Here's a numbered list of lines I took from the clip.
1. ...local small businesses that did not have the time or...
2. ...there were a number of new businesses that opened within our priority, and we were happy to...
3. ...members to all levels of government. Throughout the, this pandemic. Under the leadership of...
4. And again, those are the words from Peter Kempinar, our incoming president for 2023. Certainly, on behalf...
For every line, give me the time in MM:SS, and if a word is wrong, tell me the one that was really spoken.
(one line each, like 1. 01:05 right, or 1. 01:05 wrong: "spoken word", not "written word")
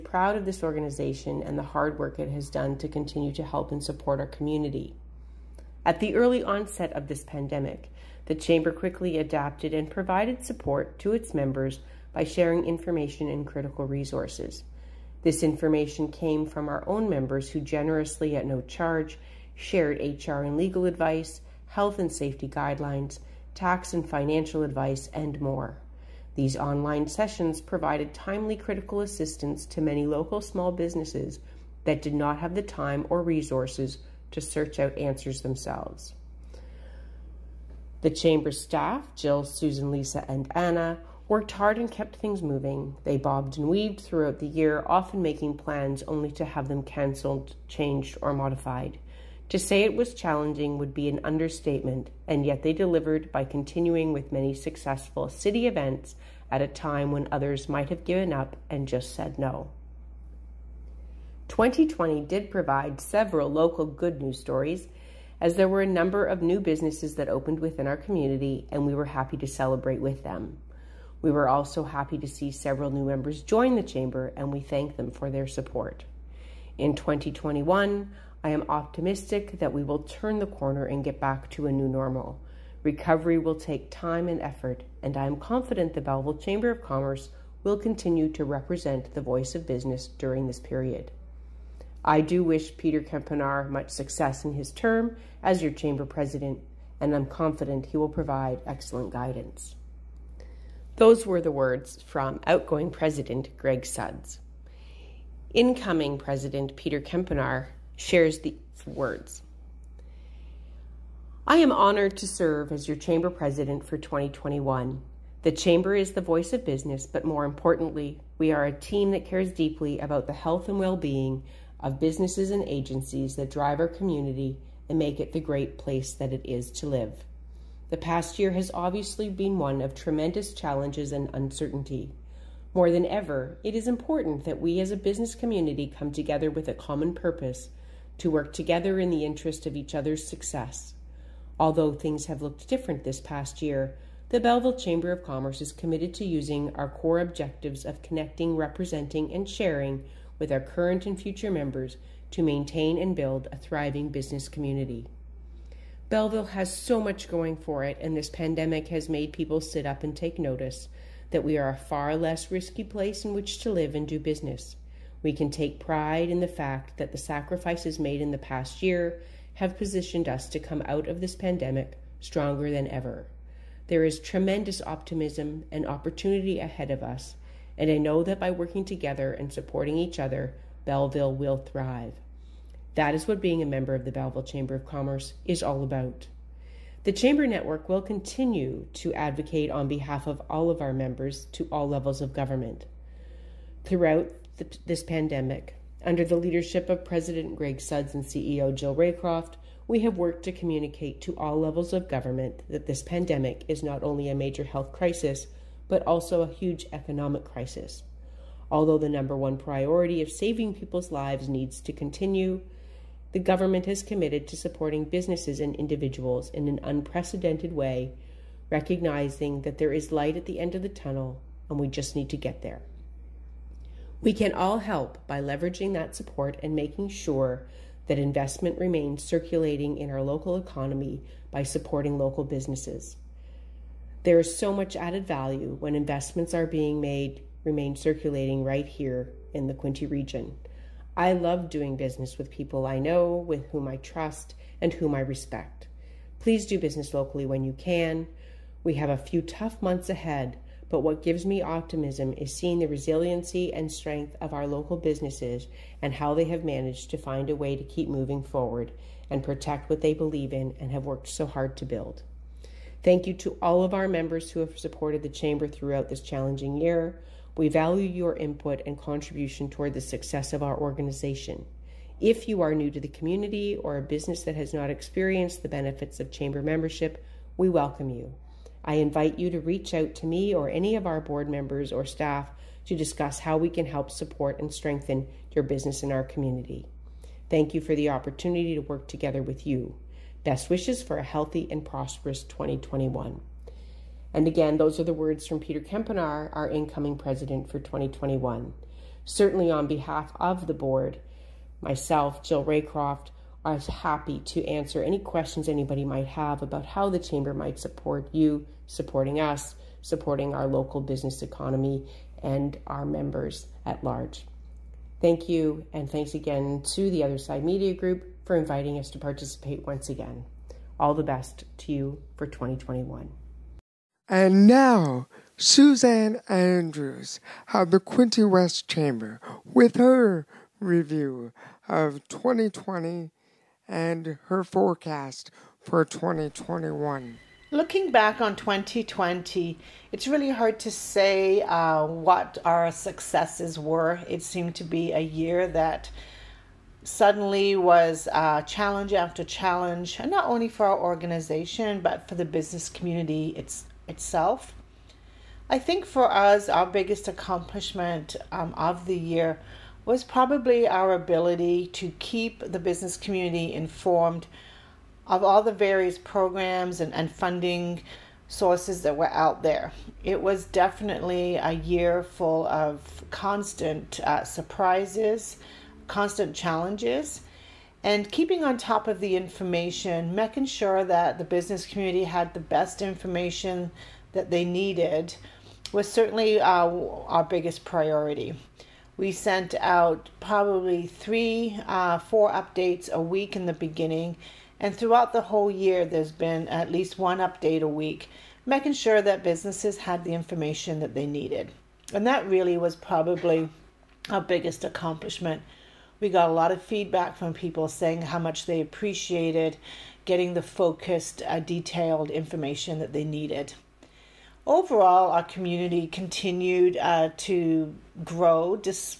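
1. 00:30 right
2. 01:05 wrong: "community", not "priority"
3. 03:10 right
4. 04:54 wrong: "2021", not "2023".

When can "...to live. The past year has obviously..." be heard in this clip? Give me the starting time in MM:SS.
02:06.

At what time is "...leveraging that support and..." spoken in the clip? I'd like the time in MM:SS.
03:45.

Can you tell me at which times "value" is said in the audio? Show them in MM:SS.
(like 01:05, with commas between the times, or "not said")
03:55, 04:27.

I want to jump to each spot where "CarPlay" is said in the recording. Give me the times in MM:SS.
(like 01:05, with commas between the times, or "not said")
not said.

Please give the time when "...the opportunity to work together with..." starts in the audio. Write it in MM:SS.
04:47.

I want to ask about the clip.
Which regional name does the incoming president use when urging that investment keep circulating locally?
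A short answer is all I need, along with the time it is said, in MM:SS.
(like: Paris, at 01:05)
Quinte region, at 03:59.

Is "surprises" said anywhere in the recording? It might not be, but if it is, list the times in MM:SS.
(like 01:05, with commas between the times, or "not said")
06:14.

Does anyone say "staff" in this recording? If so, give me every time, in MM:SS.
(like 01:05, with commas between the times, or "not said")
00:38, 04:42.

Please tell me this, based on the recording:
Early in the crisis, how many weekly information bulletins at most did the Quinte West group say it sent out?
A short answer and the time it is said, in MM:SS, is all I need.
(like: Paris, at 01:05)
4, at 06:32.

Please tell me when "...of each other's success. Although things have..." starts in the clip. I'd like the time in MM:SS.
02:19.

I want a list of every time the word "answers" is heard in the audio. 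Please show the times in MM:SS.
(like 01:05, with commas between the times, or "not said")
00:34, 05:04.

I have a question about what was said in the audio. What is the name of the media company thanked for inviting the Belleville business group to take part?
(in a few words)
Other Side Media Group.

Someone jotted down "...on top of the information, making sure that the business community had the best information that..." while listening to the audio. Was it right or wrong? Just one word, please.
right.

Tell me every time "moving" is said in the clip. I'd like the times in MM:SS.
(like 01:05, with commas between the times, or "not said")
00:42, 04:18.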